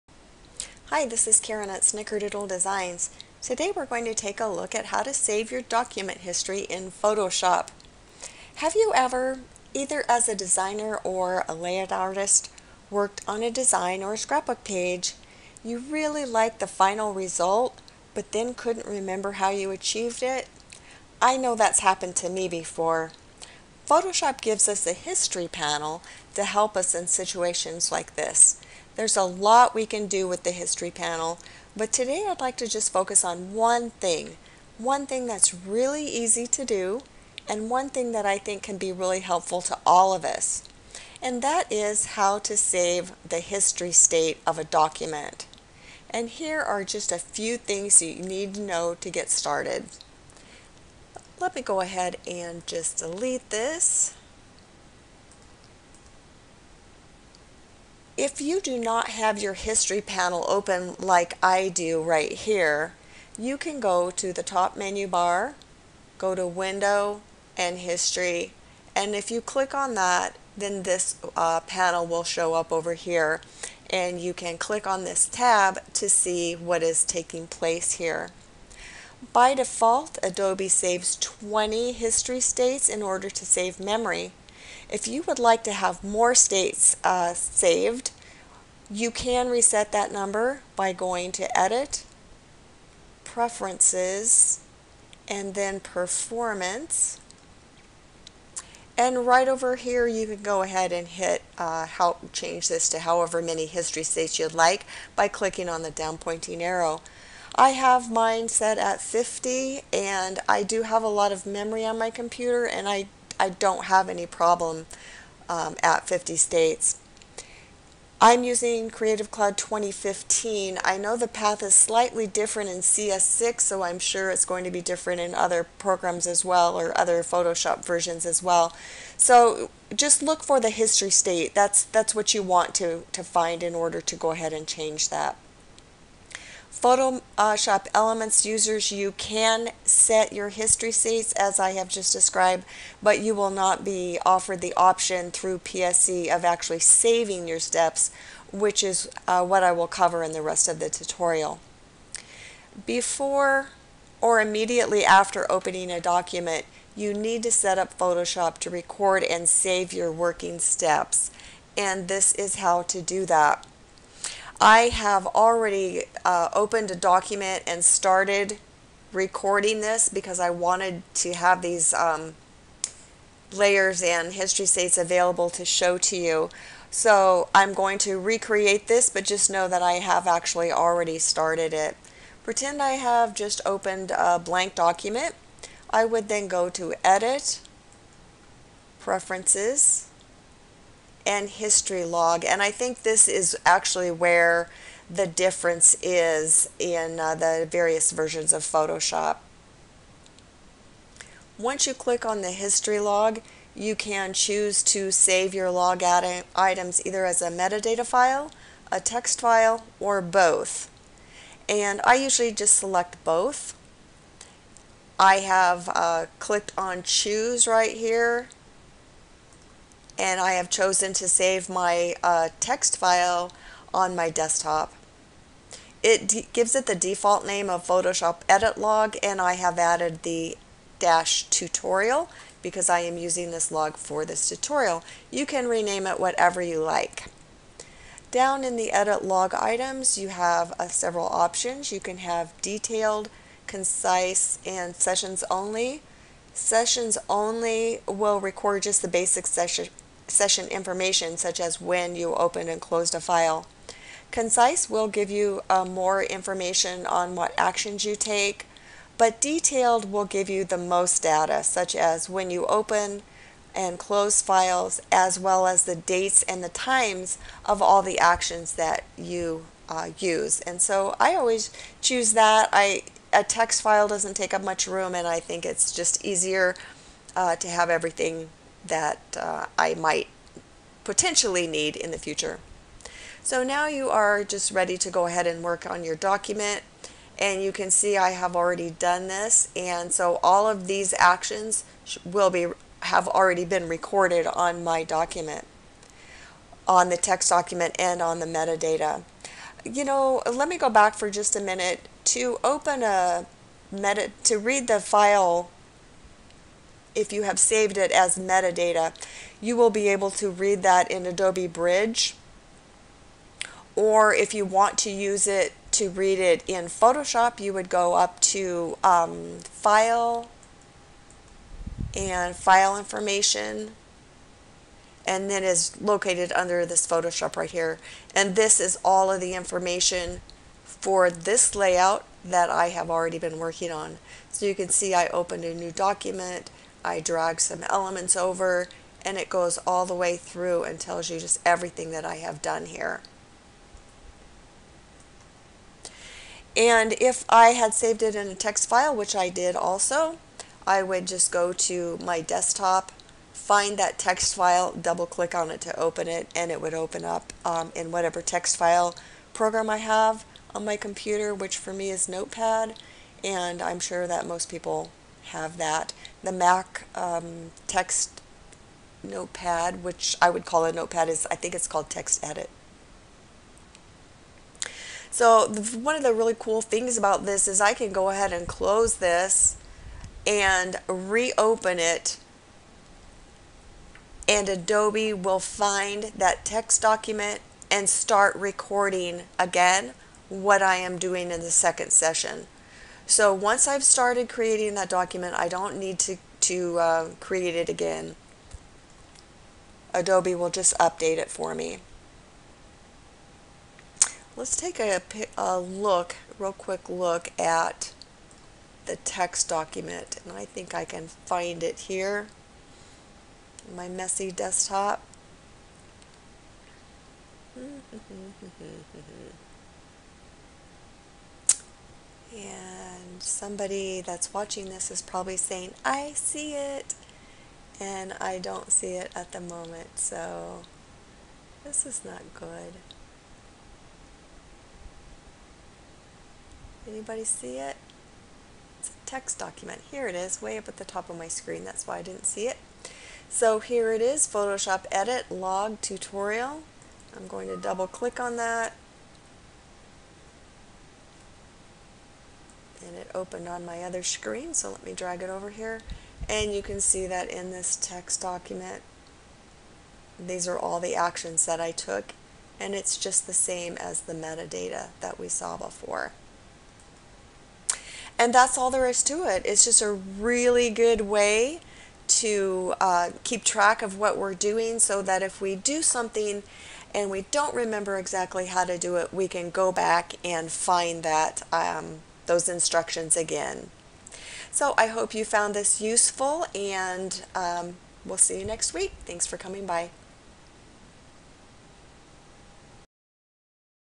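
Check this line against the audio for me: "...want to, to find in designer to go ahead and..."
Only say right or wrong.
wrong.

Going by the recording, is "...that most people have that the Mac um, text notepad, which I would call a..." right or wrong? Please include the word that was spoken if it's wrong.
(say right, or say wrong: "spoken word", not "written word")
right.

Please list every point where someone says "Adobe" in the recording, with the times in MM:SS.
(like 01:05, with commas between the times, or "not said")
01:20, 05:11, 06:24, 06:40.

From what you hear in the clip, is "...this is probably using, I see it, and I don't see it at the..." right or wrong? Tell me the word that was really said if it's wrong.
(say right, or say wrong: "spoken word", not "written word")
wrong: "saying", not "using".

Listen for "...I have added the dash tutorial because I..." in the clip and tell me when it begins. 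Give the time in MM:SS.
03:49.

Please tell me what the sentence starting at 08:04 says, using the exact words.
So I hope you found this useful and um, we'll see you next week.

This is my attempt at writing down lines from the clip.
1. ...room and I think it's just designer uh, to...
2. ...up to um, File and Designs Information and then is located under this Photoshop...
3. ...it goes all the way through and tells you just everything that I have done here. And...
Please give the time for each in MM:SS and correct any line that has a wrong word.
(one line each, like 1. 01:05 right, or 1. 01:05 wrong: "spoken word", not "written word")
1. 04:34 wrong: "easier", not "designer"
2. 05:18 wrong: "File", not "Designs"
3. 05:39 right.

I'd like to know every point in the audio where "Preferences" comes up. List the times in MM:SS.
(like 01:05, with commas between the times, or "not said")
01:33, 03:08.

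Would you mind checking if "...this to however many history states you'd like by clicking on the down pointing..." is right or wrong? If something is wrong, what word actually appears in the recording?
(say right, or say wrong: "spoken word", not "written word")
right.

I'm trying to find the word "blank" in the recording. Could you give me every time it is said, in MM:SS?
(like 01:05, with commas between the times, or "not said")
03:04.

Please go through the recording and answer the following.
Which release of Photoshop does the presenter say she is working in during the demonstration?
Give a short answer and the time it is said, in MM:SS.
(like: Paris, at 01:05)
Creative Cloud 2015, at 01:58.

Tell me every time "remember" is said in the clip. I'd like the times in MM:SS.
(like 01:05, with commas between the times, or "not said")
00:18, 07:57.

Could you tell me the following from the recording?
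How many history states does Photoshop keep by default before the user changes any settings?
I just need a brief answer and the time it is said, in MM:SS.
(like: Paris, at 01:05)
20, at 01:21.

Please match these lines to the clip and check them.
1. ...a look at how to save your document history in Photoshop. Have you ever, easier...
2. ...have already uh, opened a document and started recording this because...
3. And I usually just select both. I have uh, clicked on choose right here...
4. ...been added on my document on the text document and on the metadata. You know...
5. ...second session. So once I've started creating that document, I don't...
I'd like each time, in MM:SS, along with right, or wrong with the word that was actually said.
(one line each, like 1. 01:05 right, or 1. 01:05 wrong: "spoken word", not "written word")
1. 00:04 wrong: "either", not "easier"
2. 02:44 right
3. 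03:31 right
4. 04:53 wrong: "recorded", not "added"
5. 06:31 right.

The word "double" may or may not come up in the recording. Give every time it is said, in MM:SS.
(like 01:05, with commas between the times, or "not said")
05:54, 07:27.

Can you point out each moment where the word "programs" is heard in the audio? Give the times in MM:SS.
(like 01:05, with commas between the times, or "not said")
02:05, 05:59.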